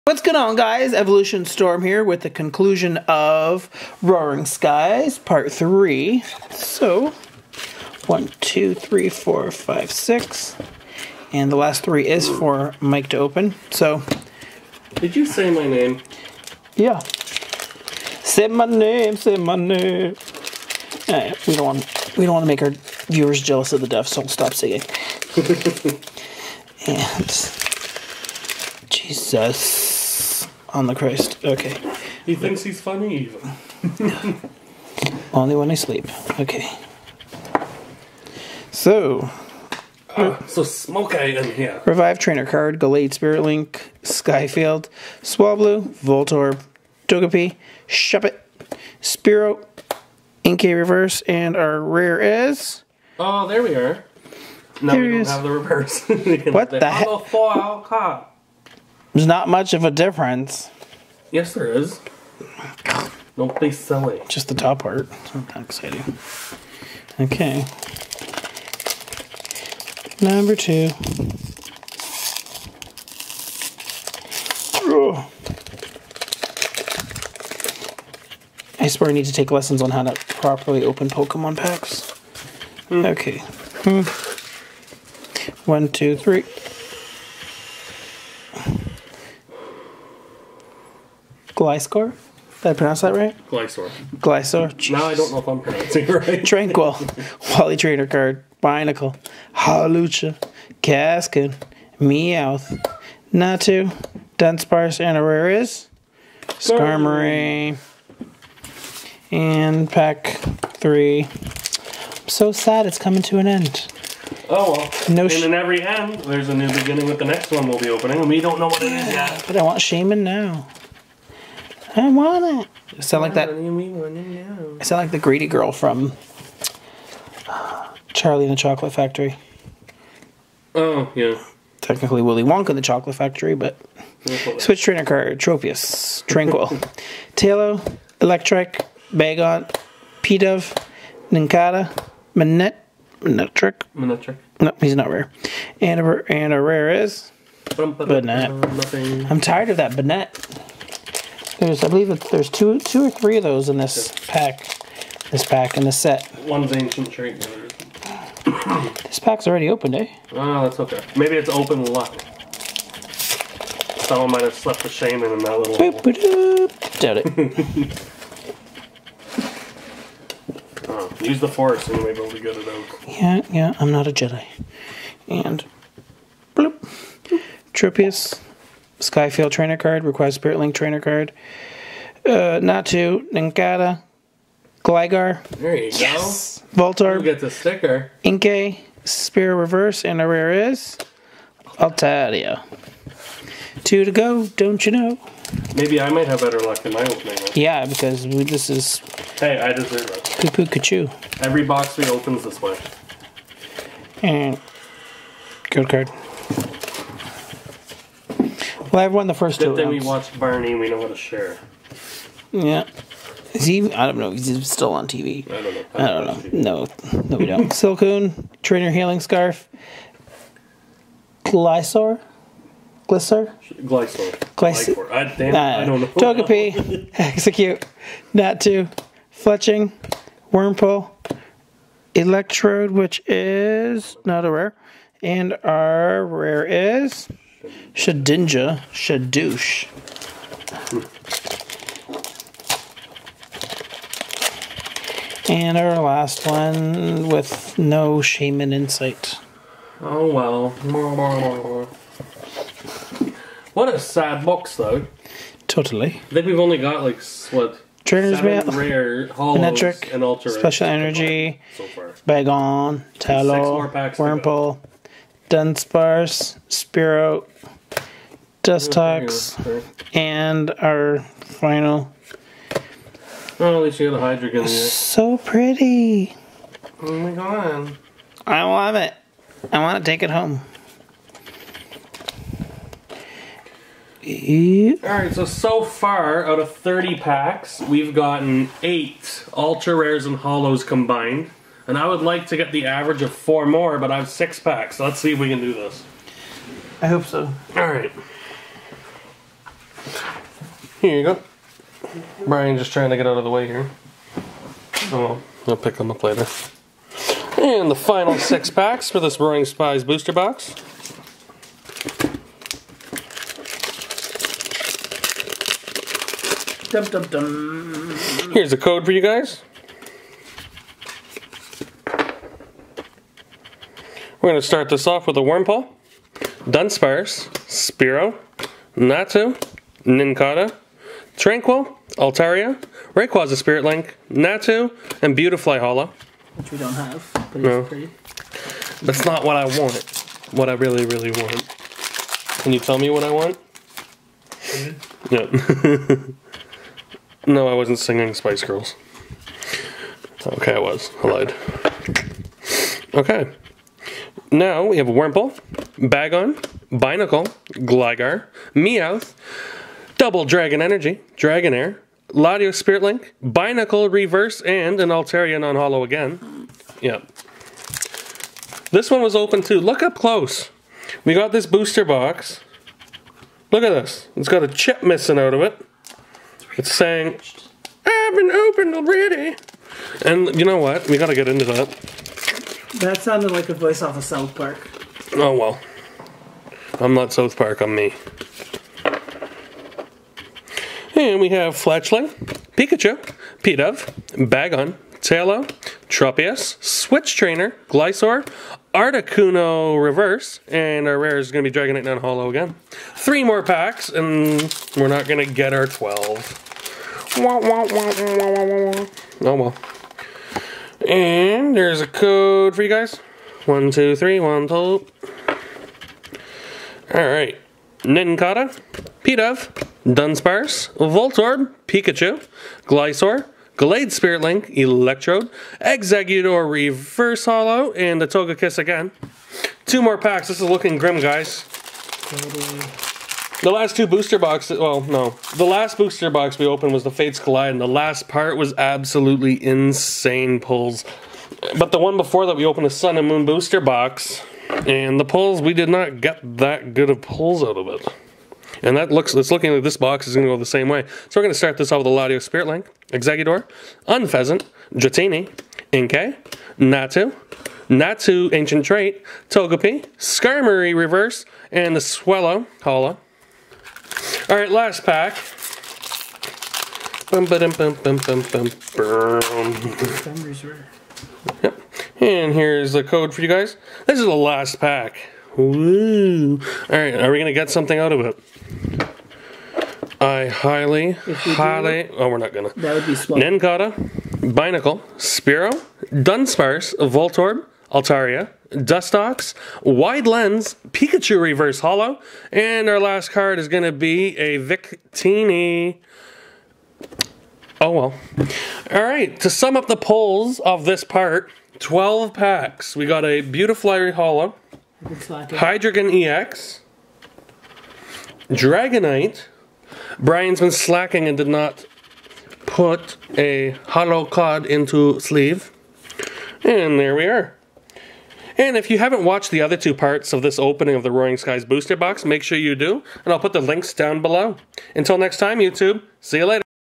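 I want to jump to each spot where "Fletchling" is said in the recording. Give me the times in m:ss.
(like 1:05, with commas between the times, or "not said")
3:49, 6:31.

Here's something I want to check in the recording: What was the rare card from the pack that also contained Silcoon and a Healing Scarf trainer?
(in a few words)
Shedinja.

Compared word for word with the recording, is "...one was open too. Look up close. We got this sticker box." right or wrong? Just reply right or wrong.
wrong.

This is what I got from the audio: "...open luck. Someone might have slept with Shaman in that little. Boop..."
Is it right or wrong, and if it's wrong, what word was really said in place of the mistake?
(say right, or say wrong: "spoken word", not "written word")
right.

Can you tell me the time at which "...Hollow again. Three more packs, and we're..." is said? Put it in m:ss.
6:42.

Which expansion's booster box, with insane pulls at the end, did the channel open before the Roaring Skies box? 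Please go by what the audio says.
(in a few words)
Fates Collide.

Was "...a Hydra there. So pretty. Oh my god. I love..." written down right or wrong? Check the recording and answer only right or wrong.
right.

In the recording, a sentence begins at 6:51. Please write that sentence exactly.
And there's a code for you guys.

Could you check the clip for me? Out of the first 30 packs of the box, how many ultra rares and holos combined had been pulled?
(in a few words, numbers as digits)
8.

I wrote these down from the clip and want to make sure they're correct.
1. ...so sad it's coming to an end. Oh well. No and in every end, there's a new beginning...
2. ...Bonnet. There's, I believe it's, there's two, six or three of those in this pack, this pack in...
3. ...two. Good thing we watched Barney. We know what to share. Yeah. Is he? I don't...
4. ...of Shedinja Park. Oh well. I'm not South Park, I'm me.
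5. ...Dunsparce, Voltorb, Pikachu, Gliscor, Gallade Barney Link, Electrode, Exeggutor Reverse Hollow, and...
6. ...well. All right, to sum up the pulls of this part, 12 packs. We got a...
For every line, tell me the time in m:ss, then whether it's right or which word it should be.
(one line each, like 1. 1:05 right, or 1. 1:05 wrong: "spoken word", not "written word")
1. 1:52 right
2. 2:29 wrong: "two", not "six"
3. 3:29 right
4. 6:24 wrong: "South", not "Shedinja"
5. 7:00 wrong: "Spirit", not "Barney"
6. 8:17 right.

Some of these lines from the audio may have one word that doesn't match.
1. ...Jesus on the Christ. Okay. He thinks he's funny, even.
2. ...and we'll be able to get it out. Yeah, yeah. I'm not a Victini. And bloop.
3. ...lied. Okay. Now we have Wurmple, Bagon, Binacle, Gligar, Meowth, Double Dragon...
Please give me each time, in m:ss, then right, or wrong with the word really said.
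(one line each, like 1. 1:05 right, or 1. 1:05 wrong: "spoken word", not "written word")
1. 0:28 right
2. 2:51 wrong: "Jedi", not "Victini"
3. 5:51 right.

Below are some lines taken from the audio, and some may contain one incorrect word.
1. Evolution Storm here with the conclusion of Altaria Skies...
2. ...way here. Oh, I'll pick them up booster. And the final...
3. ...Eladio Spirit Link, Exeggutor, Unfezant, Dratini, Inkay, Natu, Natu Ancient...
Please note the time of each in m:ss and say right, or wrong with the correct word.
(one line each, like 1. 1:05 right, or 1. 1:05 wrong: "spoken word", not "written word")
1. 0:00 wrong: "Roaring", not "Altaria"
2. 5:03 wrong: "later", not "booster"
3. 7:32 right.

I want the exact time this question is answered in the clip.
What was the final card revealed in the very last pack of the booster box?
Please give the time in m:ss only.
8:14.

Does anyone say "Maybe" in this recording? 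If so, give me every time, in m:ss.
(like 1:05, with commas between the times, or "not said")
2:41, 3:15.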